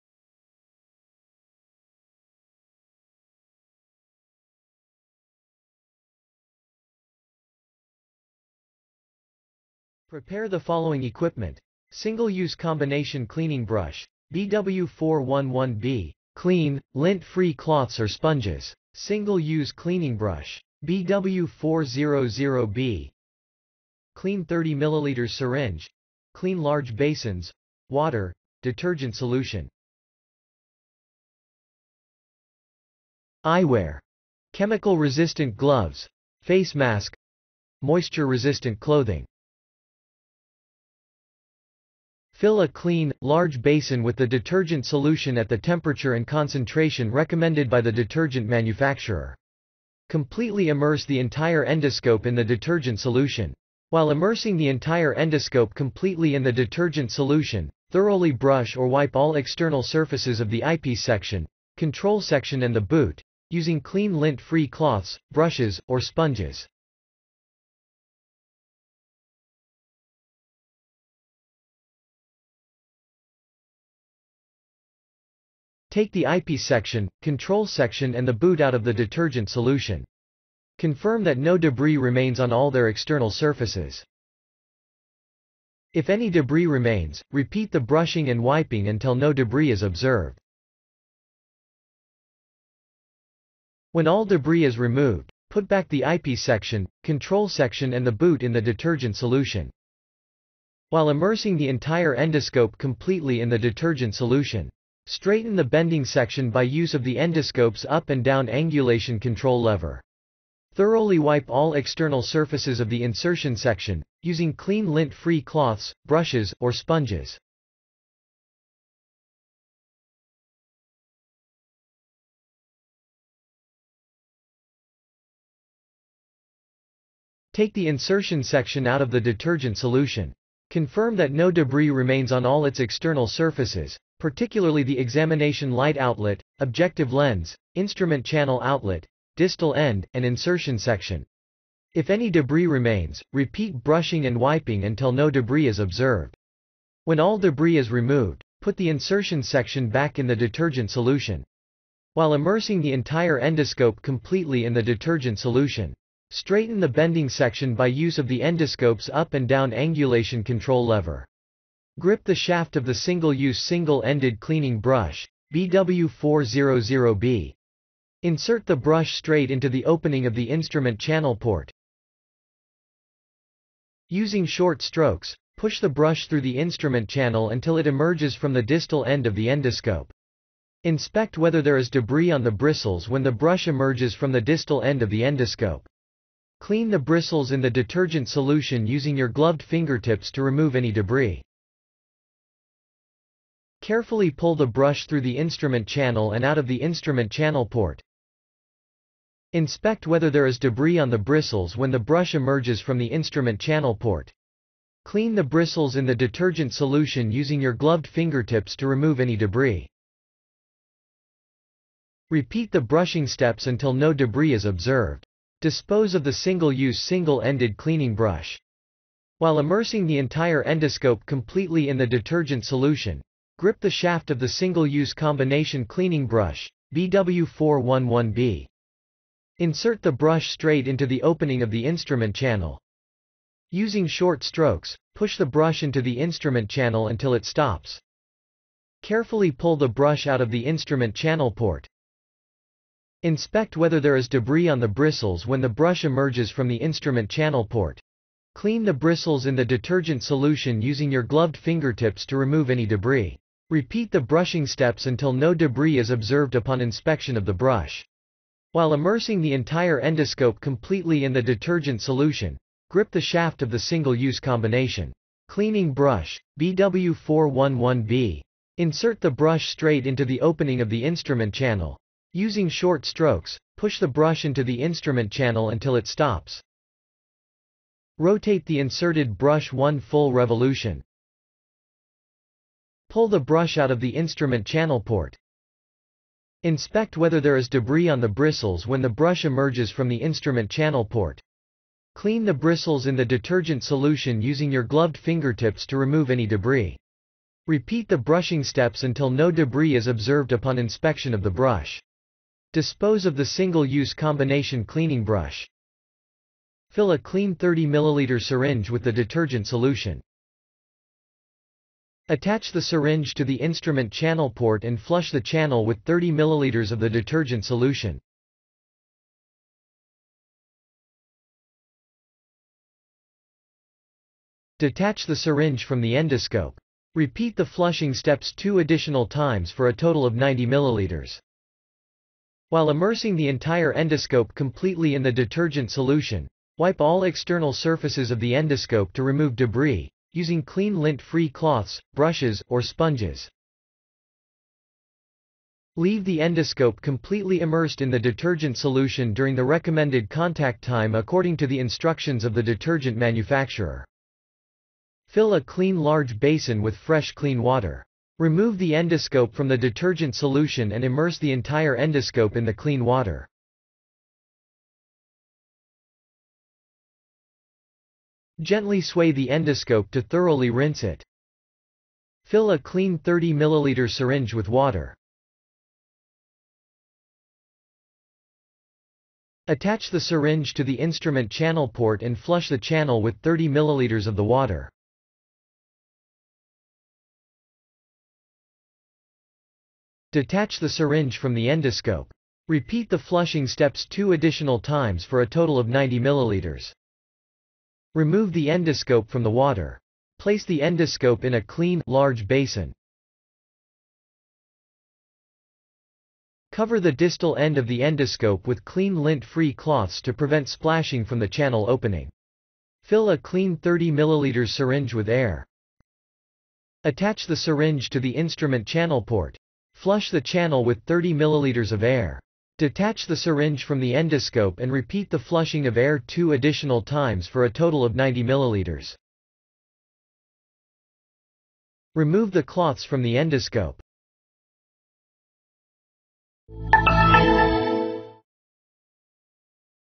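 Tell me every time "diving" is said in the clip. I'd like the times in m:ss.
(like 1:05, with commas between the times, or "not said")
not said.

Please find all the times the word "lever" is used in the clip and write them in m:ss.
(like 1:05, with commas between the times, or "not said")
1:49, 2:40.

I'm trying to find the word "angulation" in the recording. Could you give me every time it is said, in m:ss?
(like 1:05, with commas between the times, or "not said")
1:48, 2:39.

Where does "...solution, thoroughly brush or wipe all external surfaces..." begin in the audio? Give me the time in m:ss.
0:57.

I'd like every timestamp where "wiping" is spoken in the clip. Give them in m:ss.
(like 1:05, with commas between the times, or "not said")
1:28, 2:24.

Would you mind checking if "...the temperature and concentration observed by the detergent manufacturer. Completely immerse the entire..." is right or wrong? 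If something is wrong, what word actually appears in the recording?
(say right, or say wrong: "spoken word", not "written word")
wrong: "recommended", not "observed".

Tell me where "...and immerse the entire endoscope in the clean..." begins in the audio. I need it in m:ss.
6:00.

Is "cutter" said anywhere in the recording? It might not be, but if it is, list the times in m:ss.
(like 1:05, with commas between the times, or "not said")
not said.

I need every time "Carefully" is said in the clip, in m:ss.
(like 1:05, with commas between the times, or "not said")
3:13, 3:59.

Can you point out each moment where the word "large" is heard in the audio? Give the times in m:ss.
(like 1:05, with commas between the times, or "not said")
0:26, 0:43, 5:55, 6:42.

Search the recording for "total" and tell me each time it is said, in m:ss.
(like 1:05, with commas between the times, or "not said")
5:29, 6:35, 7:07.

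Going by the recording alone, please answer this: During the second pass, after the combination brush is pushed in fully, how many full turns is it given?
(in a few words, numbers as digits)
1.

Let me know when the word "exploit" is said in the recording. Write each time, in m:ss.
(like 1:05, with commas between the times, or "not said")
not said.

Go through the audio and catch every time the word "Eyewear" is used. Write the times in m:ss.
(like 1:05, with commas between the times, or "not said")
0:33.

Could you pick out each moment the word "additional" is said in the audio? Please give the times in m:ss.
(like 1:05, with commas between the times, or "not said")
5:28, 6:34, 7:06.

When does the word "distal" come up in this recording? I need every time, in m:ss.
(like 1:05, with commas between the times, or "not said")
2:19, 2:58, 3:04, 6:47.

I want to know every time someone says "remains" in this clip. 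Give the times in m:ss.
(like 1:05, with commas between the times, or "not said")
1:21, 1:26, 2:11, 2:22.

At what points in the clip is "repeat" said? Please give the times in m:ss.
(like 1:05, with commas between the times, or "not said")
1:27, 2:23, 3:32, 4:13, 4:57, 5:27, 6:32, 7:04.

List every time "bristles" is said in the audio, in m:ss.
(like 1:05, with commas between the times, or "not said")
3:02, 3:06, 3:21, 3:25, 4:04, 4:08, 4:48, 4:52.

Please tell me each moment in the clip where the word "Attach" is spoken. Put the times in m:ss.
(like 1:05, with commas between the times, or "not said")
5:12, 6:19, 6:57.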